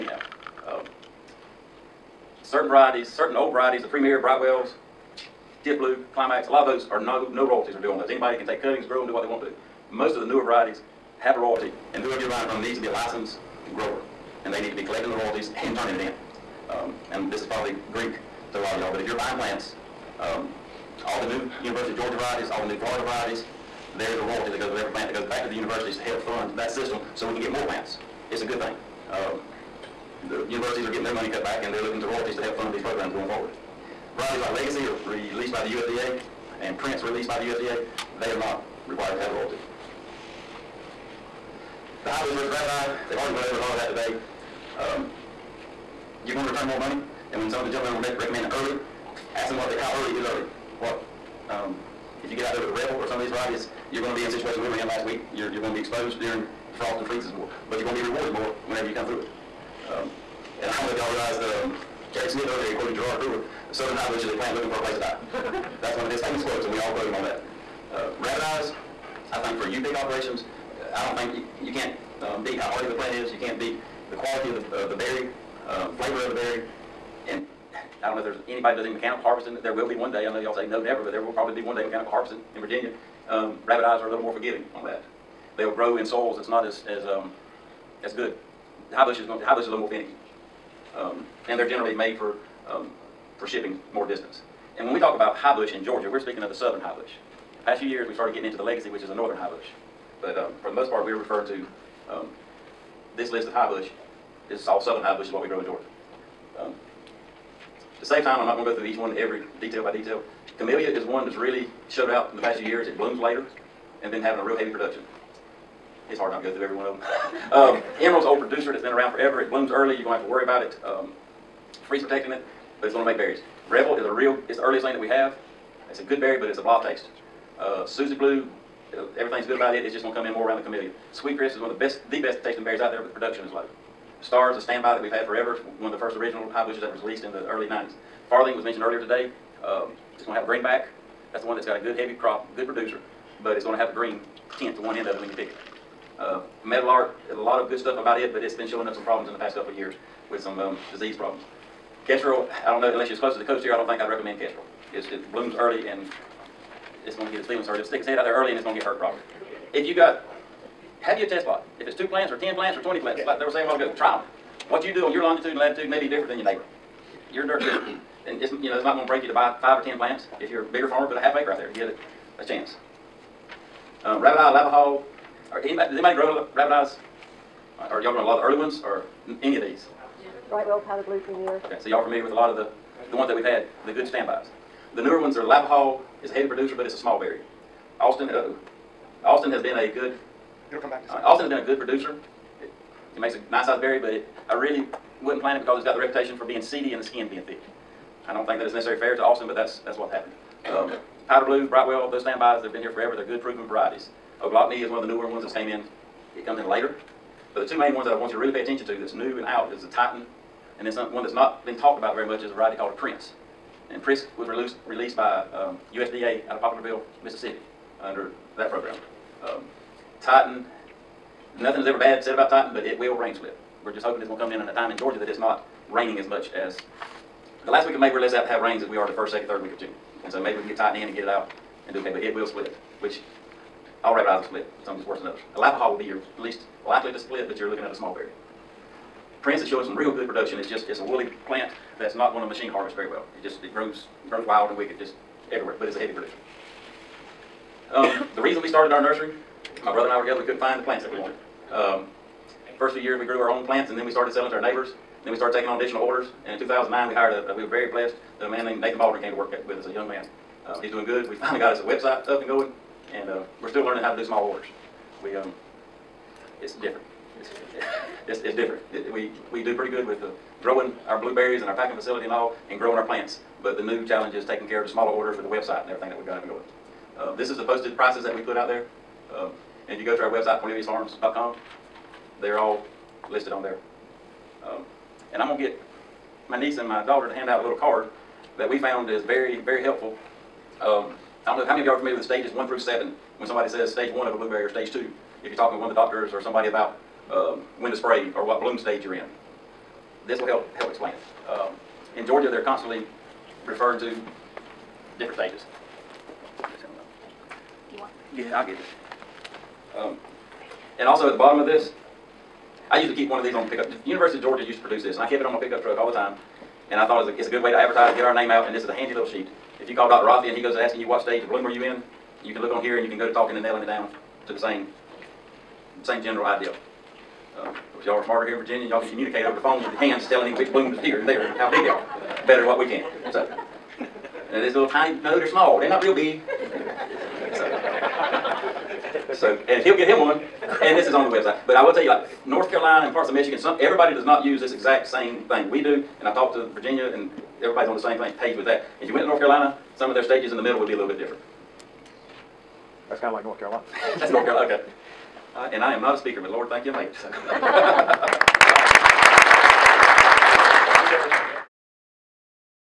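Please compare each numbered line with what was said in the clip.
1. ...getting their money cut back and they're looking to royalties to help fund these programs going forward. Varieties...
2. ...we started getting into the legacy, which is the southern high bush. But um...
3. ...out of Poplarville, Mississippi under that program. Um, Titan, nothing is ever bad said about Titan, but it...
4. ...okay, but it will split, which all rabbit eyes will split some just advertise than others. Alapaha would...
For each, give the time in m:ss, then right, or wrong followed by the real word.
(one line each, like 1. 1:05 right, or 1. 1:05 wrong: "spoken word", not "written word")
1. 0:30 right
2. 1:38 wrong: "northern", not "southern"
3. 3:36 right
4. 3:51 wrong: "worse", not "advertise".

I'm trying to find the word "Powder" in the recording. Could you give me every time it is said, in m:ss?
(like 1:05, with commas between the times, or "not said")
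3:00, 3:21.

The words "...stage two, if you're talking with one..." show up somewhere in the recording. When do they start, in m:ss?
4:54.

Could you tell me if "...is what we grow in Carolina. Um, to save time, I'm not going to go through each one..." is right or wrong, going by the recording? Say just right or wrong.
wrong.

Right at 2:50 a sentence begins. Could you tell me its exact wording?
If you're a bigger farmer, put a half acre out there to give it a chance.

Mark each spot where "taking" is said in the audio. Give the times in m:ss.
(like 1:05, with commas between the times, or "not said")
4:15, 4:34.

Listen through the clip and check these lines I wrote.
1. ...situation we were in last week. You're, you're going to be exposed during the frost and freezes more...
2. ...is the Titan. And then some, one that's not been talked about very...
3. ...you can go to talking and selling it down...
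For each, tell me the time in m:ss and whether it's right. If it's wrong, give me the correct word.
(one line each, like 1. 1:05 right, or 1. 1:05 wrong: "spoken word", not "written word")
1. 0:54 right
2. 3:29 right
3. 5:23 wrong: "nailing", not "selling".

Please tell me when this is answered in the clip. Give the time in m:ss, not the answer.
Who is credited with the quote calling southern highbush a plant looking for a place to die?
1:02.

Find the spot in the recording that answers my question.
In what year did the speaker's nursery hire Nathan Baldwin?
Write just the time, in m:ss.
4:16.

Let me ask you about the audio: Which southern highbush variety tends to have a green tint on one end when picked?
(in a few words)
Farthing.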